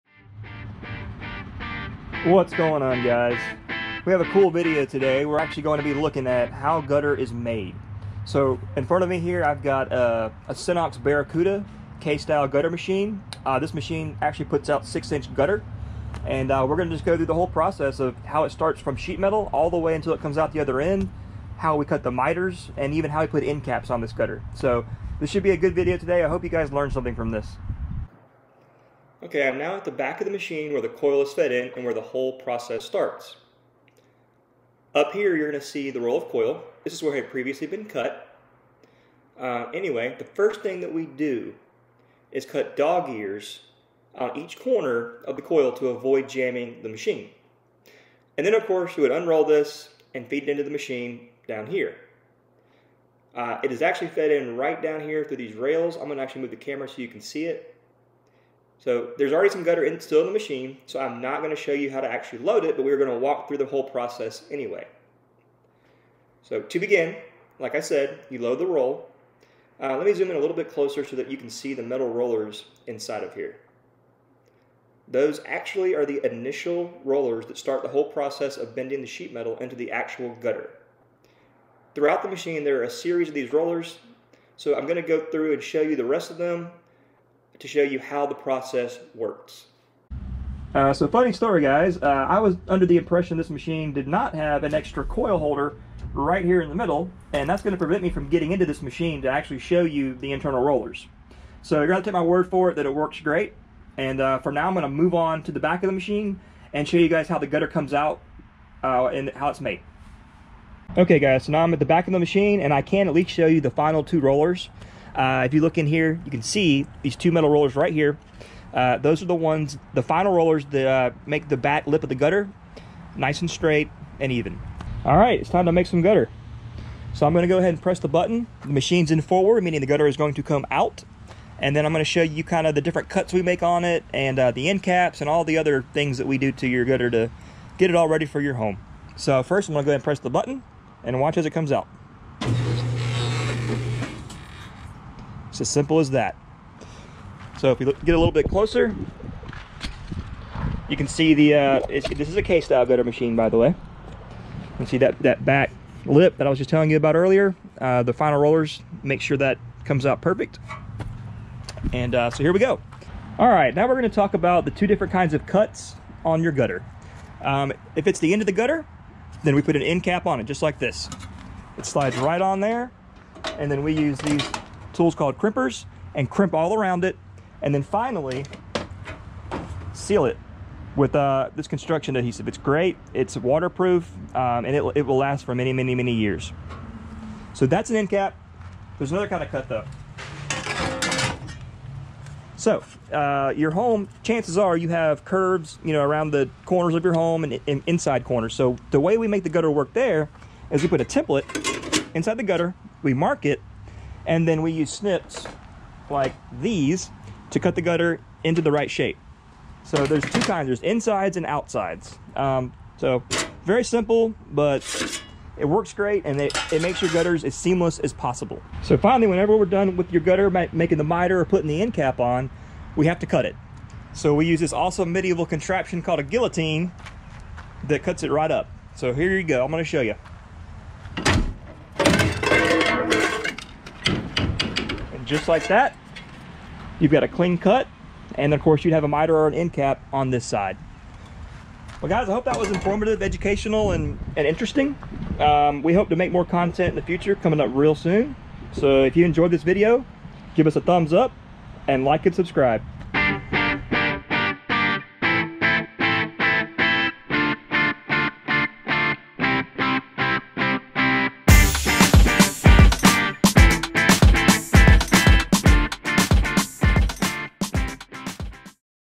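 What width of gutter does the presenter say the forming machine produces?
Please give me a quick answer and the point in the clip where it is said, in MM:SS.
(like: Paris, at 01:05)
6 inch, at 00:14.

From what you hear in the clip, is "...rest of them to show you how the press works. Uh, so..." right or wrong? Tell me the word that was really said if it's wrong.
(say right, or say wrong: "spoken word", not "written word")
wrong: "process", not "press".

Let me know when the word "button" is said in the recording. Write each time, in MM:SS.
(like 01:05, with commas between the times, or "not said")
02:08, 02:20.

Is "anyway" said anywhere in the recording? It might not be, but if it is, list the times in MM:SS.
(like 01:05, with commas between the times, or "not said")
00:39, 01:04.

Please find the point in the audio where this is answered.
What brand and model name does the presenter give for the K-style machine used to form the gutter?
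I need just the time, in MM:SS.
00:10.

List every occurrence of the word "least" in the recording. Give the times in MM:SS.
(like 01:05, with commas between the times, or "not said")
01:53.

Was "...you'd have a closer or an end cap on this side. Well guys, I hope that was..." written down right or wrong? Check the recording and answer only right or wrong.
wrong.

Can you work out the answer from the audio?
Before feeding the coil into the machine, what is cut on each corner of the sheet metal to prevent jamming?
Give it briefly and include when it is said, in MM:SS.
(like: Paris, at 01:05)
Dog ears, at 00:42.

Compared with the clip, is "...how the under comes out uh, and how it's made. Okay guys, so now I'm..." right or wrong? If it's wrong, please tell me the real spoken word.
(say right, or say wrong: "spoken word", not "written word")
wrong: "gutter", not "under".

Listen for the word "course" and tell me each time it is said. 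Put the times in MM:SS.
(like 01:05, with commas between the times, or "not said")
00:48, 03:58.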